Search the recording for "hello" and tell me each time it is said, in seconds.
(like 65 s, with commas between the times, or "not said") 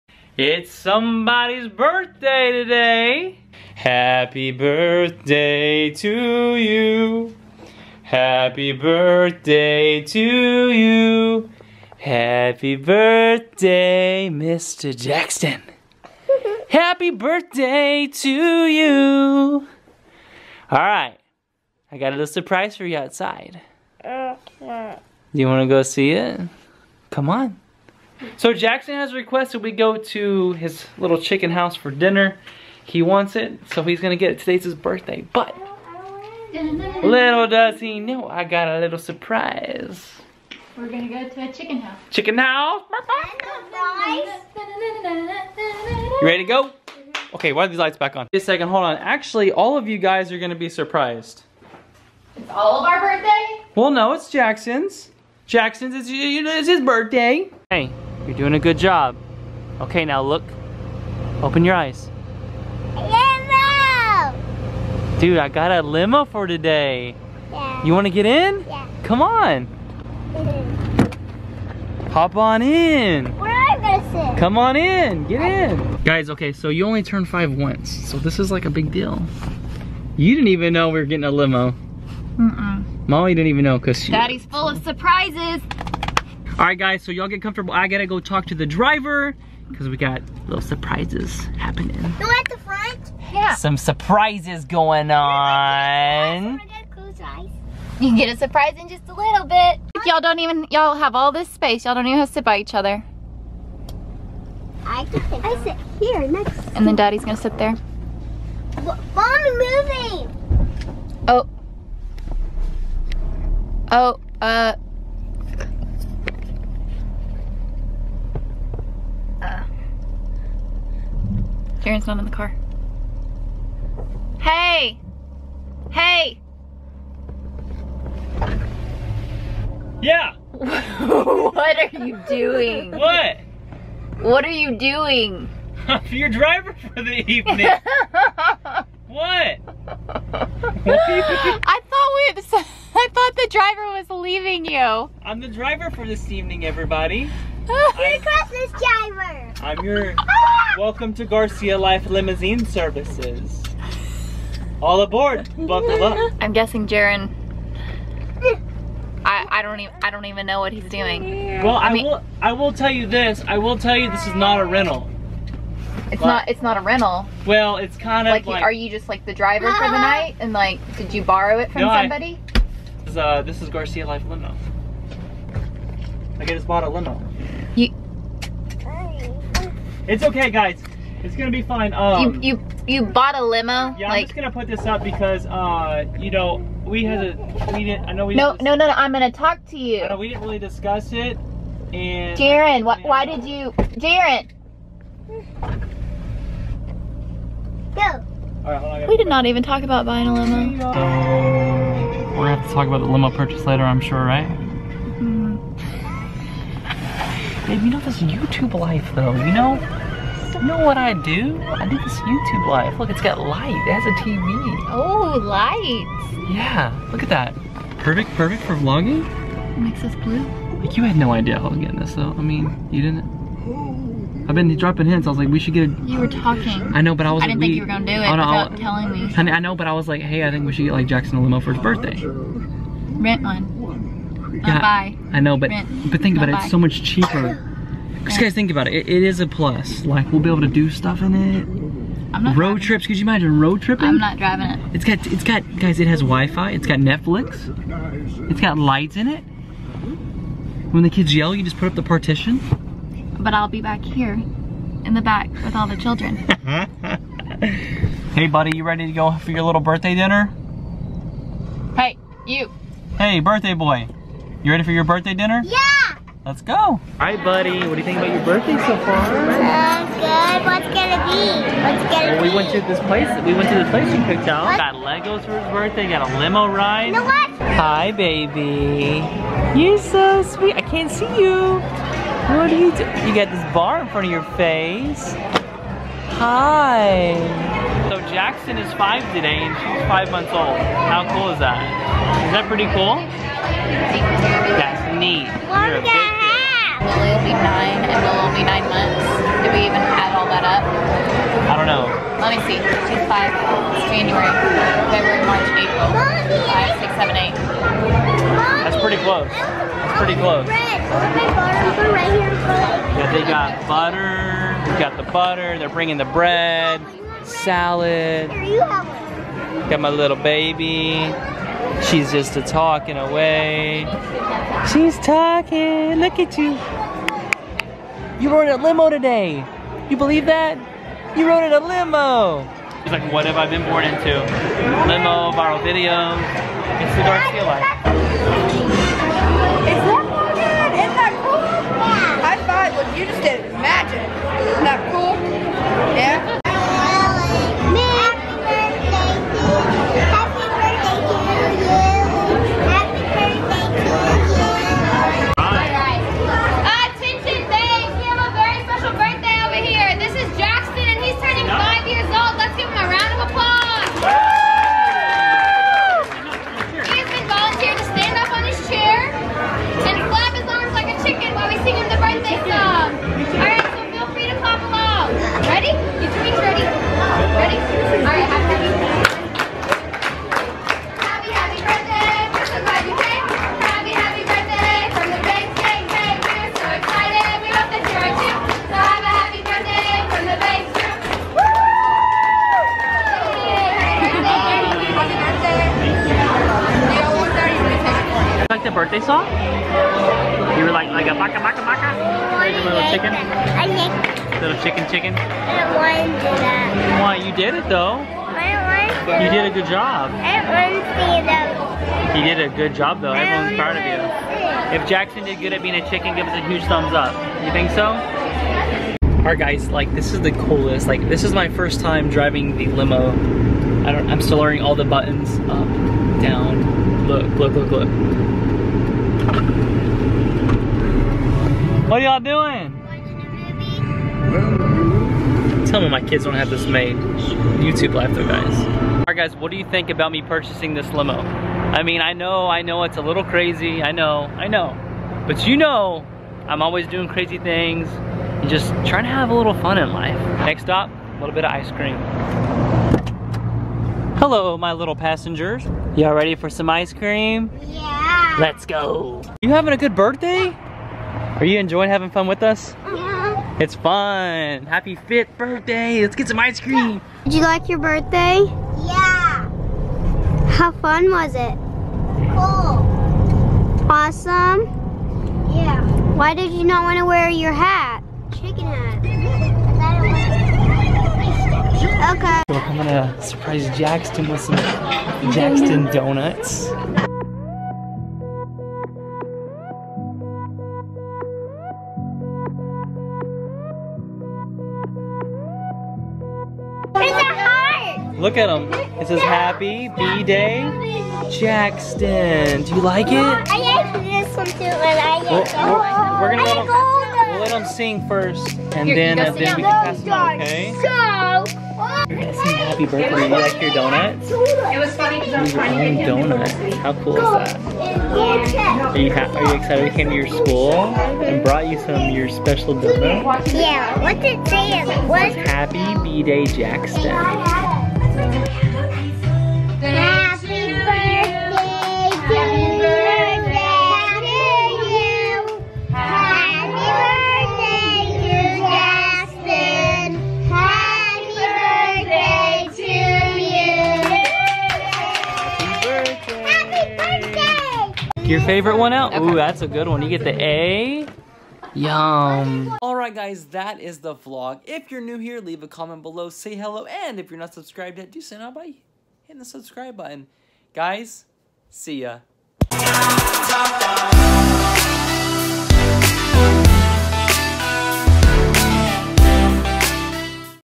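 454 s, 556 s.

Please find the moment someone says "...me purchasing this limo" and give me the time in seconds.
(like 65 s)
440 s.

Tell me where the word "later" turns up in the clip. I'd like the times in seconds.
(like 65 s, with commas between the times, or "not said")
203 s.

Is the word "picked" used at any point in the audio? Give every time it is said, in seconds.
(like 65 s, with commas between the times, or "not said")
274 s.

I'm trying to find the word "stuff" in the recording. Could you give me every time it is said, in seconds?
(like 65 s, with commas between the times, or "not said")
240 s.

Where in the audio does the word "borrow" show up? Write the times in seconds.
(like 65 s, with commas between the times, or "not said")
171 s.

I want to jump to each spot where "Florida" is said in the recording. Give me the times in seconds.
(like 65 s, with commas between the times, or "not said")
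not said.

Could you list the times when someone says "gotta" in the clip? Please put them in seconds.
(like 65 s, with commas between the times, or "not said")
87 s.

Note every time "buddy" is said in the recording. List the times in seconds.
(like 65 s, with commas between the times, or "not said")
258 s, 267 s.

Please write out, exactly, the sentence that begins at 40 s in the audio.
We're gonna go to a chicken house.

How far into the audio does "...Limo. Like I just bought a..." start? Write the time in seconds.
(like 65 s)
174 s.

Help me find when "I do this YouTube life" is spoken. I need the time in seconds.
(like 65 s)
211 s.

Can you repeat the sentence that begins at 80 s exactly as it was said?
You didn't even know we were getting a limo.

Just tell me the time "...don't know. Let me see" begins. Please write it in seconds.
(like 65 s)
301 s.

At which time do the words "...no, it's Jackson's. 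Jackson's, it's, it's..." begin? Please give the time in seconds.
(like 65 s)
53 s.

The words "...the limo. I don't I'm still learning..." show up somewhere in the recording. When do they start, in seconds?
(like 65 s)
422 s.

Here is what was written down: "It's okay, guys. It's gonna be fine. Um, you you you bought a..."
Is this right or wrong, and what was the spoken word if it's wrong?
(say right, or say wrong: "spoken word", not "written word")
right.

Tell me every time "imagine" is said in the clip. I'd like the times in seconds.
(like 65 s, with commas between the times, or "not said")
243 s.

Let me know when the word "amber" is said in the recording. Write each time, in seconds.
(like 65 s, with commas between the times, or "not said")
not said.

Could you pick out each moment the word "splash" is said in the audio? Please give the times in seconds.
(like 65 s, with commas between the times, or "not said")
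not said.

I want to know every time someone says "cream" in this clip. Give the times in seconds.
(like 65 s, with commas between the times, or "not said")
451 s, 457 s, 466 s.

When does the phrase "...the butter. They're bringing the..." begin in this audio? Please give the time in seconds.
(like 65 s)
315 s.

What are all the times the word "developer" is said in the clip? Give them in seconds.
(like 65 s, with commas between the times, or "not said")
not said.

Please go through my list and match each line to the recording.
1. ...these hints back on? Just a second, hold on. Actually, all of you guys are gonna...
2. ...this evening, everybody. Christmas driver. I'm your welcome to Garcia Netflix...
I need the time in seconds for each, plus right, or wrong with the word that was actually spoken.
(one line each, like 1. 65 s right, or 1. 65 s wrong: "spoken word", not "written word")
1. 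47 s wrong: "lights", not "hints"
2. 146 s wrong: "Life", not "Netflix".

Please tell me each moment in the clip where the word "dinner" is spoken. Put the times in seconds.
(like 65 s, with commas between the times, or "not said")
31 s, 260 s, 265 s.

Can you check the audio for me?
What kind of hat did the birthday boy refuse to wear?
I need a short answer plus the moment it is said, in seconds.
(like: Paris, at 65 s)
Chicken hat, at 478 s.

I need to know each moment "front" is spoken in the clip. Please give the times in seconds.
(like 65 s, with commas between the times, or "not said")
92 s, 284 s.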